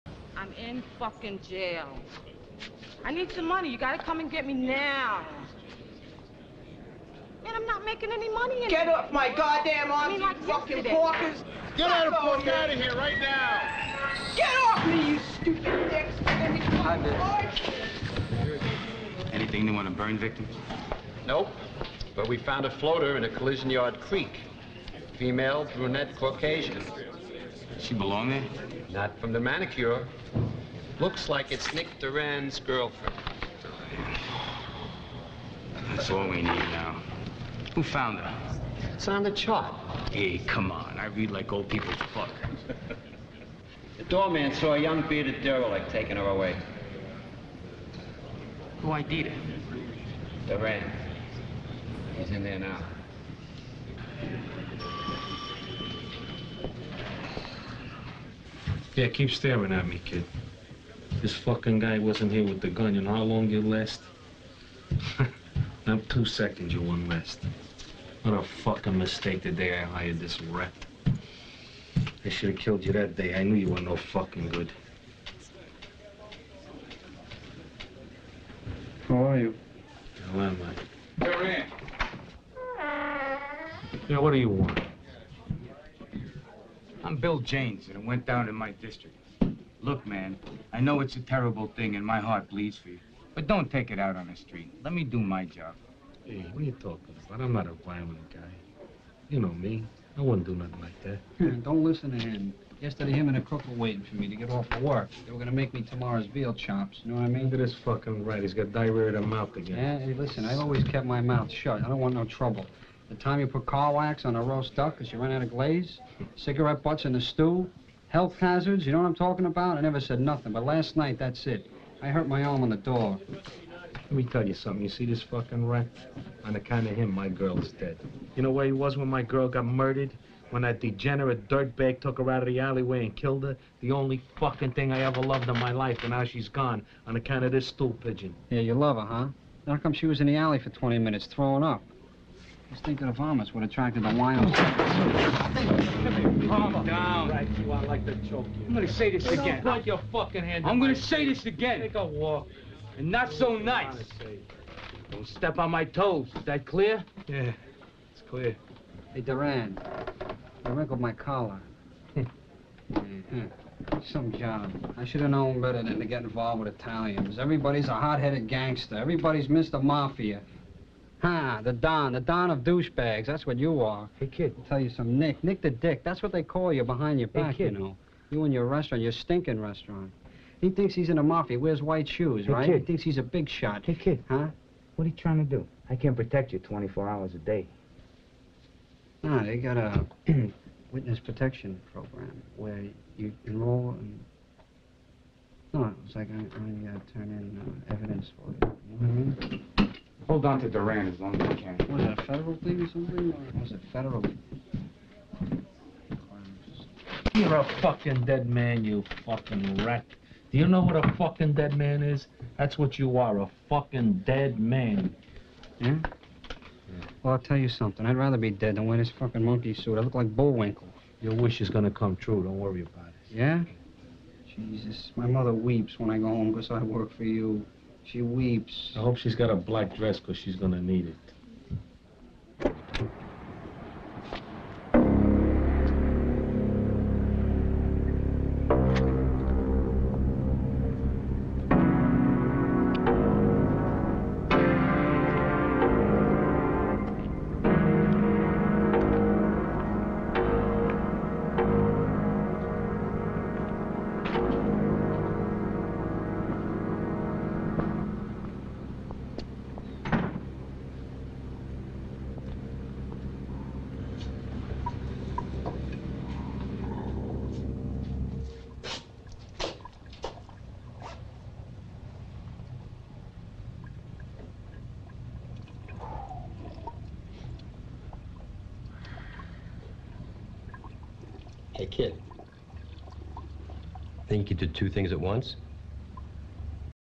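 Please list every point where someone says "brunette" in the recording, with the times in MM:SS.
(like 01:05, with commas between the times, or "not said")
00:25.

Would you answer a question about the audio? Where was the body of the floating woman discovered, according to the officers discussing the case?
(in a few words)
Collision yard creek.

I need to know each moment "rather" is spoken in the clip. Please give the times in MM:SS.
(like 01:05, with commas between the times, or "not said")
03:38.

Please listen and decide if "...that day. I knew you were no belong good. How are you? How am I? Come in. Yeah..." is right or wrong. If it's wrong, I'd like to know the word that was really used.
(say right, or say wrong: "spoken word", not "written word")
wrong: "fucking", not "belong".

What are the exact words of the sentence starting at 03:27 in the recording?
You're a fucking dead man, you fucking rat.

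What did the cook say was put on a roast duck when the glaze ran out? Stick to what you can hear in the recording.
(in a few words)
Car wax.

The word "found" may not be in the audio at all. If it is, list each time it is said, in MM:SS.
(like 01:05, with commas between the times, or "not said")
00:22, 00:37.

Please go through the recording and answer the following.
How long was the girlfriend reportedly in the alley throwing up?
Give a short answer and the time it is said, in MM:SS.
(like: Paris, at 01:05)
20 minutes, at 02:20.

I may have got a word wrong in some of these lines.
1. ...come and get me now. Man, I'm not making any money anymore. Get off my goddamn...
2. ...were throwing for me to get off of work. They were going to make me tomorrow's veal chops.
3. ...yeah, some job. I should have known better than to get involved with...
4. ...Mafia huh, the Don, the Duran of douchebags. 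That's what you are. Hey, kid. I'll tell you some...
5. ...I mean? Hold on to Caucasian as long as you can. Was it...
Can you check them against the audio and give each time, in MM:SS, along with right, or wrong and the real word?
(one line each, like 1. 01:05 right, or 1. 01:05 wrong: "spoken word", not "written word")
1. 00:04 right
2. 01:43 wrong: "waiting", not "throwing"
3. 02:42 right
4. 02:49 wrong: "Don", not "Duran"
5. 03:19 wrong: "Duran", not "Caucasian".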